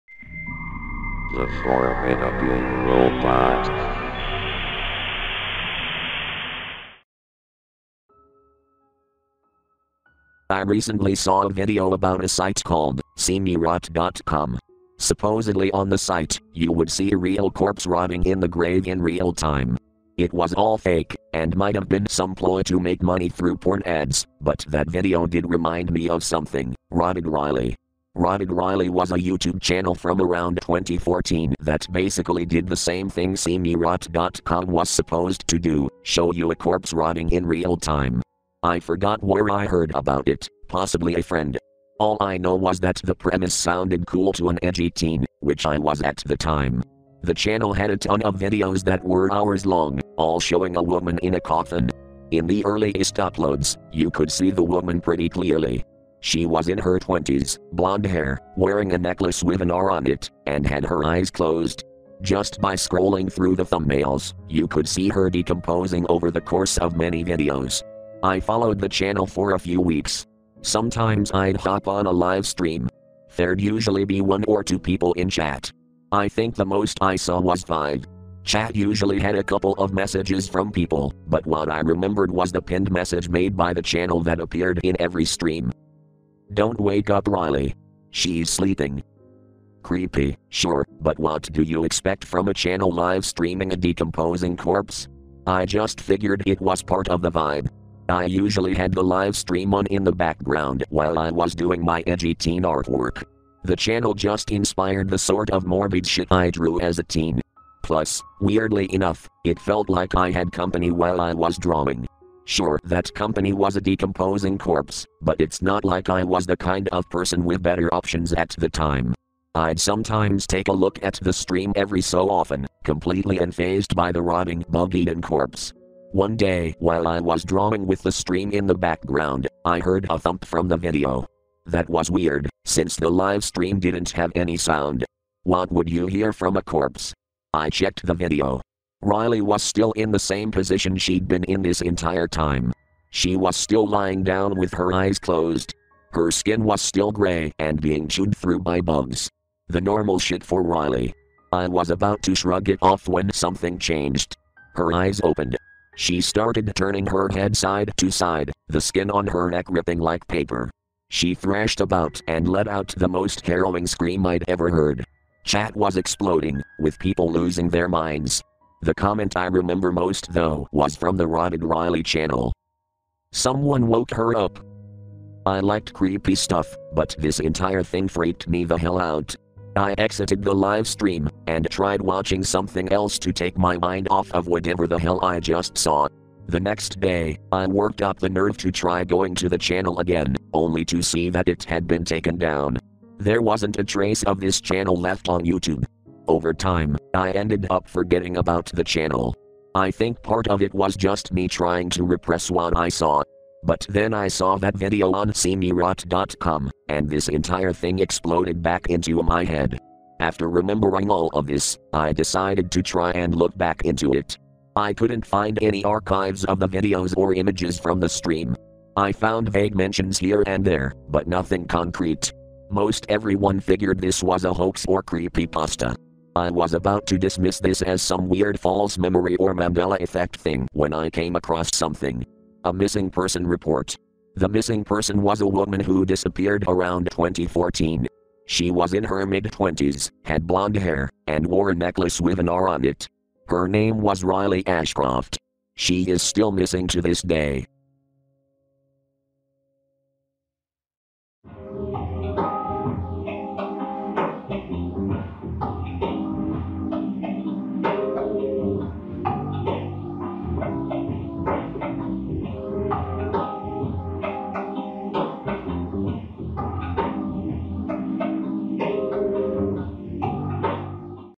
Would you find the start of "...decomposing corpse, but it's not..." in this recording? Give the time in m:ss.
1:53.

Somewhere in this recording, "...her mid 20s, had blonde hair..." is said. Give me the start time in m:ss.
3:59.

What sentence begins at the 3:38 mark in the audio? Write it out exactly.
I found vague mentions here and there, but nothing concrete.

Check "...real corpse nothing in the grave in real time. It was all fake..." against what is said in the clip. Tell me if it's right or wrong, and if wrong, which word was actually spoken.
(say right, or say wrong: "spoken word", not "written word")
wrong: "rotting", not "nothing".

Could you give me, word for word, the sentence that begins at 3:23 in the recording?
But then I saw that video on SeeMeRot.com, and this entire thing exploded back into my head.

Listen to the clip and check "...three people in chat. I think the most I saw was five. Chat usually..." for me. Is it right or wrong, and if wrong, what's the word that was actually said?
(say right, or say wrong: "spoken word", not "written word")
wrong: "two", not "three".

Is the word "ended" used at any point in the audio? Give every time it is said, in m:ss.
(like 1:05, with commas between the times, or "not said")
3:17.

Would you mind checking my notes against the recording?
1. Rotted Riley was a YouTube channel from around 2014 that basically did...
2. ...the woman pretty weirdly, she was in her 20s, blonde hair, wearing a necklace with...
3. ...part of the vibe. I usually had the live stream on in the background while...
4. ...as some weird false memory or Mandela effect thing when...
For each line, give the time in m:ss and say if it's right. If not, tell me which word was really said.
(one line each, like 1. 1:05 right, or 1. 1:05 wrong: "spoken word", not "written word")
1. 0:28 right
2. 0:54 wrong: "clearly", not "weirdly"
3. 1:36 right
4. 3:47 right.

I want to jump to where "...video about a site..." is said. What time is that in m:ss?
0:11.